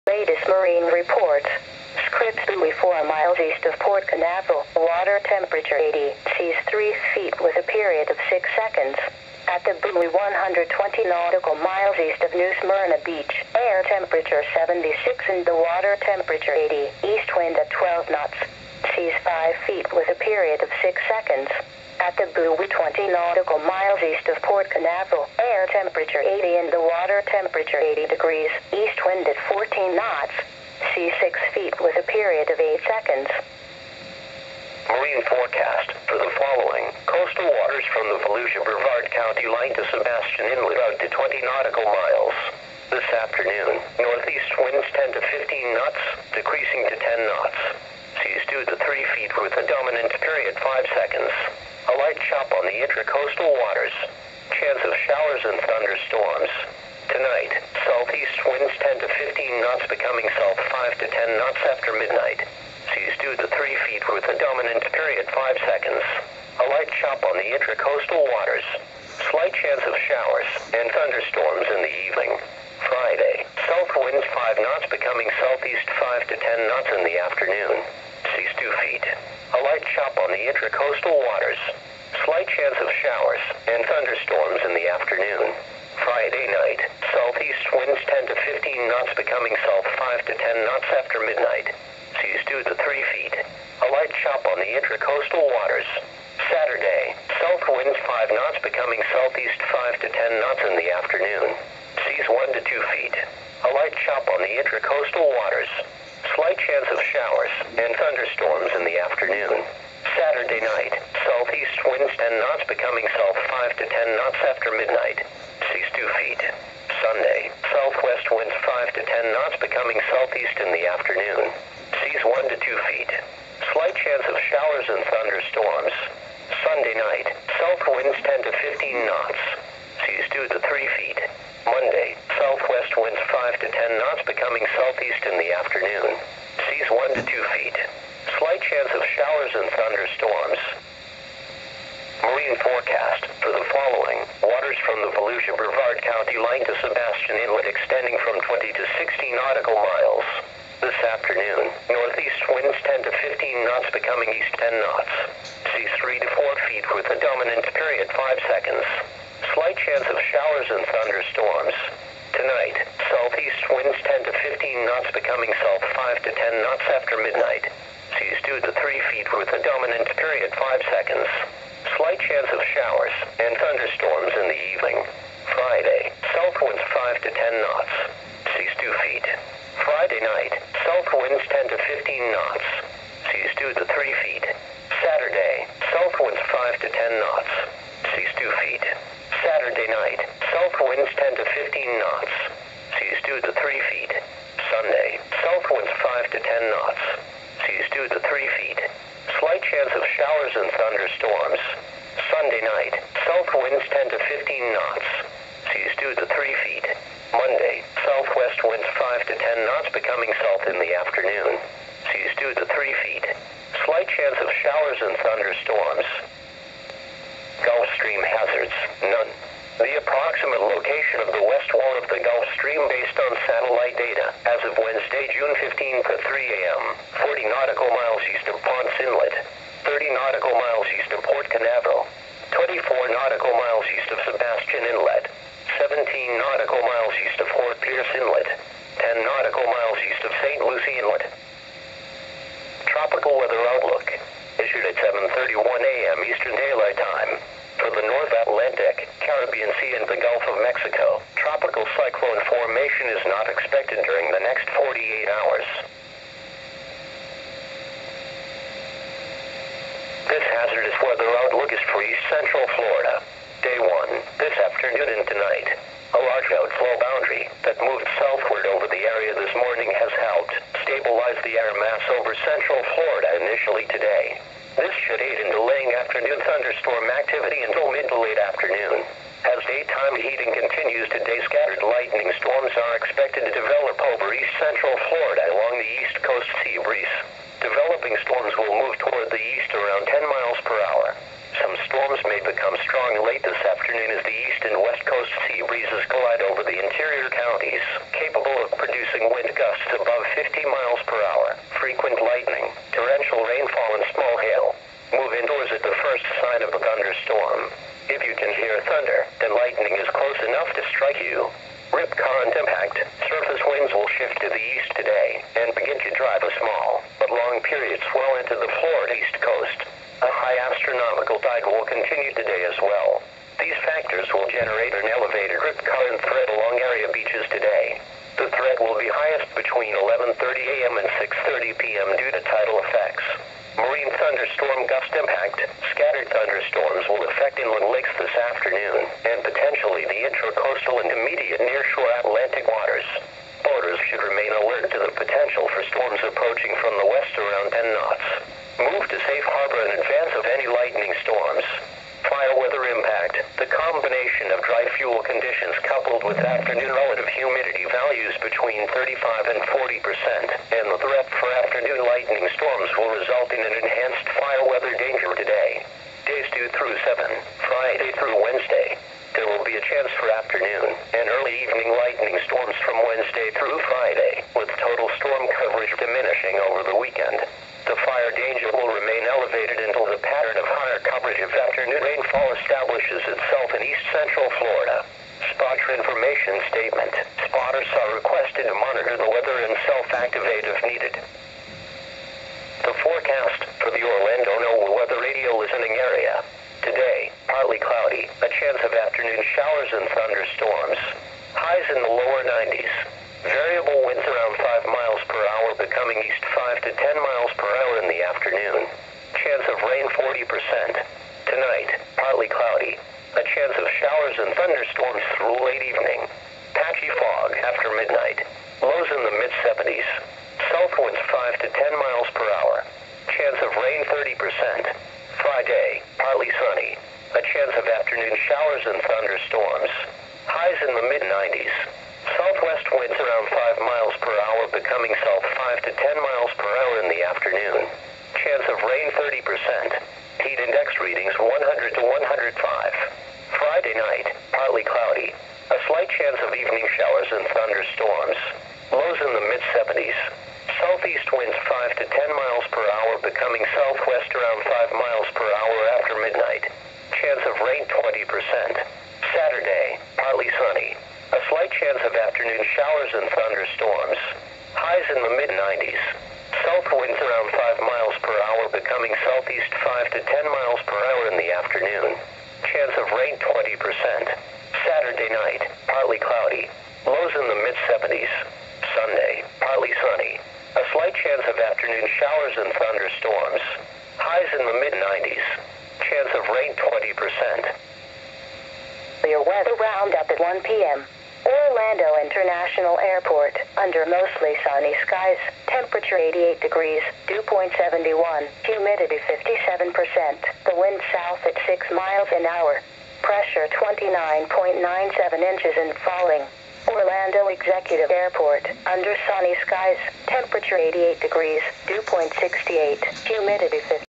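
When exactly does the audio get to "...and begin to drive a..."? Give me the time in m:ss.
5:15.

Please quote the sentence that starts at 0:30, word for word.
Sea 6 feet with a period of 8 seconds.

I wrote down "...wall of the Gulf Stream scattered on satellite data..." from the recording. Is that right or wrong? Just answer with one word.
wrong.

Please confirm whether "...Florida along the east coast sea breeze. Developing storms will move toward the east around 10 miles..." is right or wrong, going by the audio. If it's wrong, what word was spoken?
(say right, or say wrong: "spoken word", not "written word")
right.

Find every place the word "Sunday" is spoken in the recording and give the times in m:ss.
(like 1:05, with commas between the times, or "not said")
1:57, 2:06, 7:58.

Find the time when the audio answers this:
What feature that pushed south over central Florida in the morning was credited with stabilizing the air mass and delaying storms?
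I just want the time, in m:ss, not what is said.
4:26.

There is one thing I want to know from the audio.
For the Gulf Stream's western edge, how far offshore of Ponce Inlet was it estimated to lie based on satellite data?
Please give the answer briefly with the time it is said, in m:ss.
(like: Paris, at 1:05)
40 nautical miles, at 3:47.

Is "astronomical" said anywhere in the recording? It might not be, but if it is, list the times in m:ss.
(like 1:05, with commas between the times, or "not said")
5:20.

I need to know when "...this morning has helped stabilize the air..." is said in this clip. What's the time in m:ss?
4:29.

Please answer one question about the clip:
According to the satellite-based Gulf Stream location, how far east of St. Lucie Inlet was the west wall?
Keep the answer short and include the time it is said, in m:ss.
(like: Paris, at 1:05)
10 nautical miles, at 3:59.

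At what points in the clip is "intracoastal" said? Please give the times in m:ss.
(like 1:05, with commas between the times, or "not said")
0:52, 1:07, 1:20, 1:34, 1:44, 5:40.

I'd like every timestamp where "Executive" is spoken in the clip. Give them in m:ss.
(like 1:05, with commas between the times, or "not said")
8:27.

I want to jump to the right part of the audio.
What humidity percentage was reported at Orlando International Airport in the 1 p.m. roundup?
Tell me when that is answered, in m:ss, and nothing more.
8:18.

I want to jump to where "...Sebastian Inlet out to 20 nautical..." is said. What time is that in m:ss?
0:39.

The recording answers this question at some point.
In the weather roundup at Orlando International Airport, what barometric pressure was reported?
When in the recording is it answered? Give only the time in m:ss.
8:23.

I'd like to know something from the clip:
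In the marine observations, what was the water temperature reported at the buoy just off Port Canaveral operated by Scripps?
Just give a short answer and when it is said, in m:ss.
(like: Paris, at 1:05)
80, at 0:04.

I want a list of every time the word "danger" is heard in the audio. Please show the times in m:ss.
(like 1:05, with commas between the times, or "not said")
6:04, 6:18.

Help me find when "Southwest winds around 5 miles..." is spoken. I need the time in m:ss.
7:12.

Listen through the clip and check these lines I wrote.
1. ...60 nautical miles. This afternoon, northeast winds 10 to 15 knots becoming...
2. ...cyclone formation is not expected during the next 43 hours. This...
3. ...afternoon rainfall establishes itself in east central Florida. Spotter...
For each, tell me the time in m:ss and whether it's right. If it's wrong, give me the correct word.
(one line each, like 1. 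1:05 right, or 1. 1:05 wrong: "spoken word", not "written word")
1. 2:28 right
2. 4:11 wrong: "48", not "43"
3. 6:21 right.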